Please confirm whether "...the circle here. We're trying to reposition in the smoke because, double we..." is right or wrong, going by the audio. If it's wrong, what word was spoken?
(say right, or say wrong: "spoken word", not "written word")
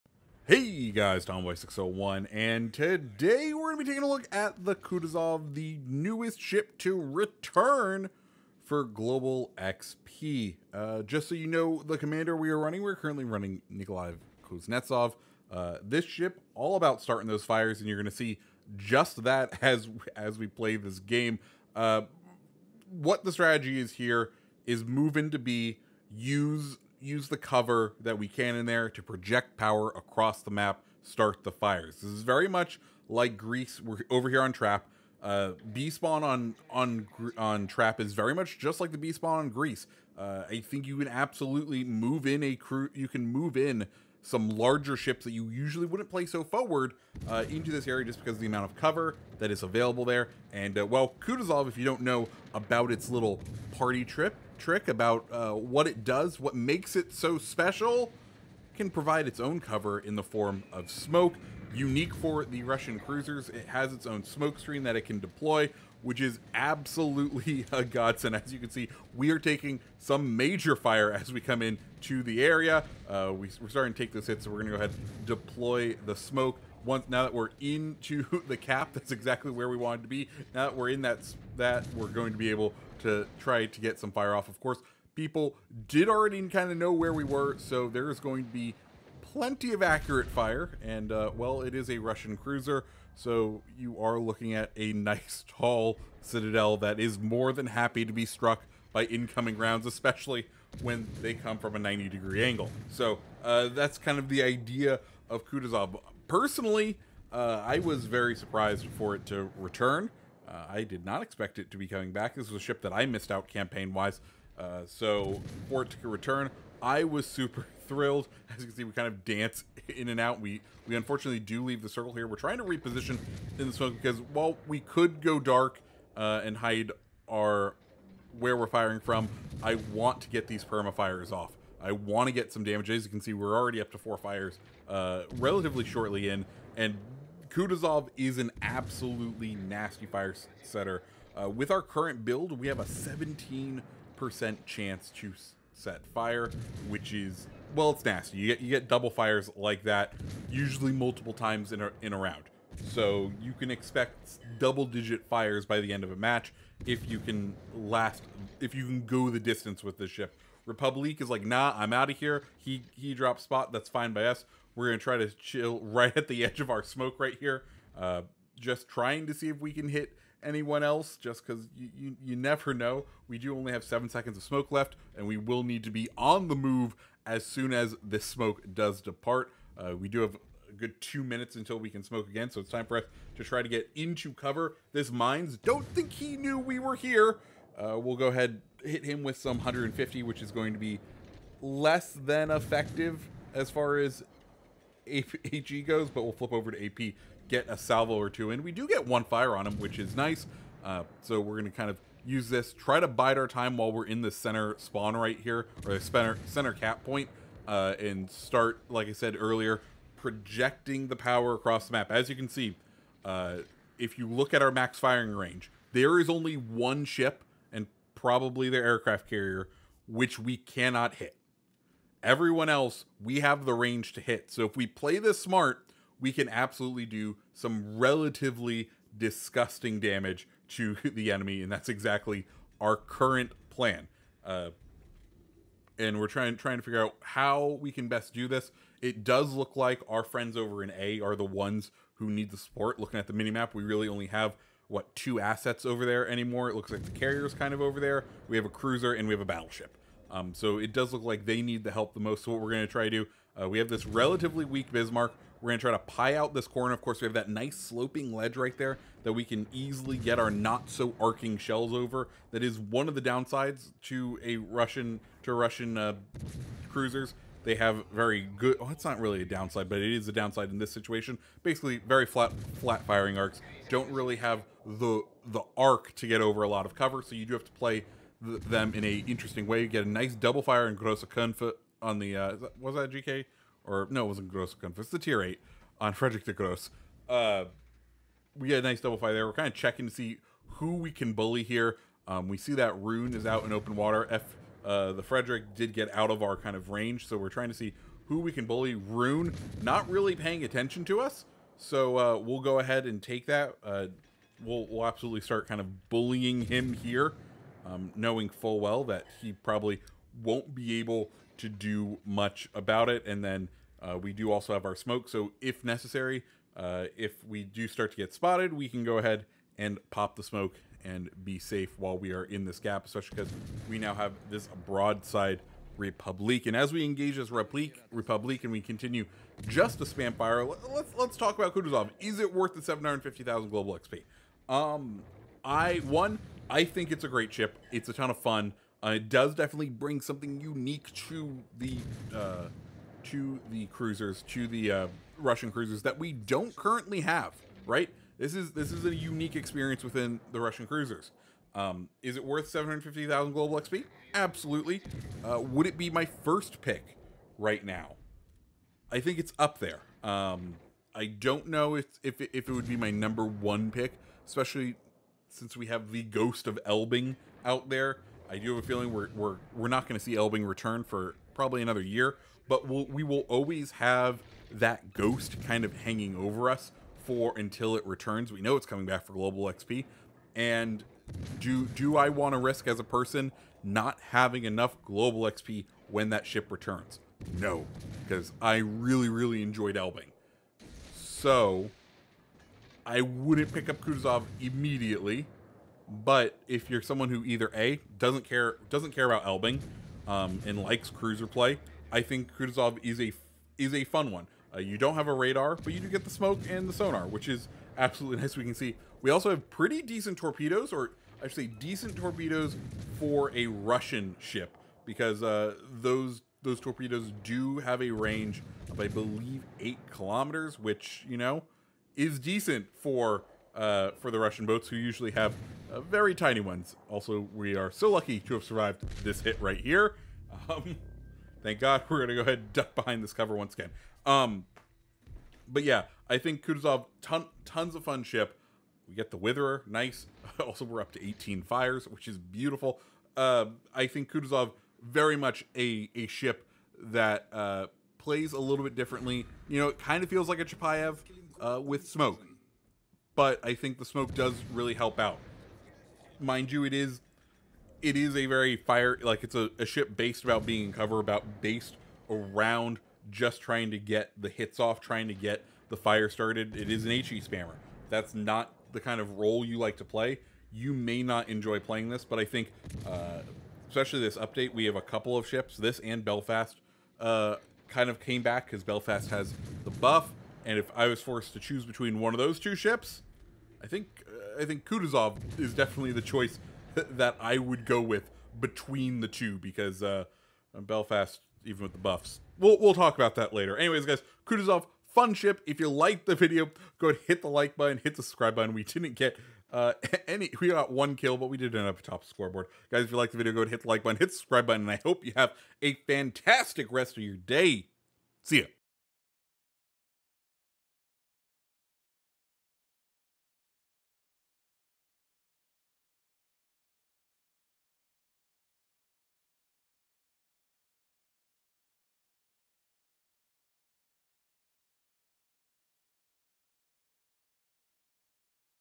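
wrong: "while", not "double".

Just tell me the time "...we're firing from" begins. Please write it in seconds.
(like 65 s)
128 s.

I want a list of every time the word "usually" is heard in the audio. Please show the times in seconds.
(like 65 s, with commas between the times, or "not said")
45 s, 150 s, 424 s.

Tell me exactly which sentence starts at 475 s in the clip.
This and Belfast uh, kind of came back because Belfast has the buff.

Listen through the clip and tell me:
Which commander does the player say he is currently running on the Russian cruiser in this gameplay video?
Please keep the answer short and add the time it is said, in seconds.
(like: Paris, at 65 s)
Nikolai Kuznetsov, at 13 s.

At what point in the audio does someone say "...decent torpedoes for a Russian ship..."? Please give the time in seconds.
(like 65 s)
411 s.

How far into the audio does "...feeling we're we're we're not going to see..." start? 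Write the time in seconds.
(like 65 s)
368 s.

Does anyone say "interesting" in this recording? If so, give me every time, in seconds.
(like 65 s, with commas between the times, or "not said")
279 s.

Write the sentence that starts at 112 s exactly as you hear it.
This was a ship that I missed out campaign wise.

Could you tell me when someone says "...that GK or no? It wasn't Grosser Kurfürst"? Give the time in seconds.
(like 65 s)
282 s.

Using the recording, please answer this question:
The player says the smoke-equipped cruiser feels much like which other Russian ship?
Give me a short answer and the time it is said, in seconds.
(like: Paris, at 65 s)
Chapayev, at 450 s.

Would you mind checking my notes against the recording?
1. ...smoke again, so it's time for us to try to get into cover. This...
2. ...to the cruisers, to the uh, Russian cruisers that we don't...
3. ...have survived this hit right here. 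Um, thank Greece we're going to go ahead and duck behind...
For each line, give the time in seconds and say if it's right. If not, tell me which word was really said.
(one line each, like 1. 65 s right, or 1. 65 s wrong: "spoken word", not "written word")
1. 182 s right
2. 343 s right
3. 428 s wrong: "God", not "Greece".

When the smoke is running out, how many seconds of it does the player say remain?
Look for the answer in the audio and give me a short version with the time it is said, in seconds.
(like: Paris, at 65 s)
7, at 173 s.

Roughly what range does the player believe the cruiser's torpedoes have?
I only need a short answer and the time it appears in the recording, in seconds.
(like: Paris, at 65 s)
8 kilometers, at 419 s.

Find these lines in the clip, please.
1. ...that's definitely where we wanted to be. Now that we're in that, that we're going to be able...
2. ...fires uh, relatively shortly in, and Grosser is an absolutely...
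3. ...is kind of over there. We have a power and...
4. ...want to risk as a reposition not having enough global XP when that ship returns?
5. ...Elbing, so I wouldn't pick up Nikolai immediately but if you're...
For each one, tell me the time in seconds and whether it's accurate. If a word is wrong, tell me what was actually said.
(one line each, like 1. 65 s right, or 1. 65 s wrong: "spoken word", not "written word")
1. 78 s wrong: "exactly", not "definitely"
2. 134 s wrong: "Kutuzov", not "Grosser"
3. 247 s wrong: "cruiser", not "power"
4. 382 s wrong: "person", not "reposition"
5. 389 s wrong: "Kutuzov", not "Nikolai".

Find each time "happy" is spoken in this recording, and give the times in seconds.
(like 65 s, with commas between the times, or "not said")
97 s.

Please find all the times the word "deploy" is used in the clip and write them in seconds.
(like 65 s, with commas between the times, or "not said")
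65 s, 75 s.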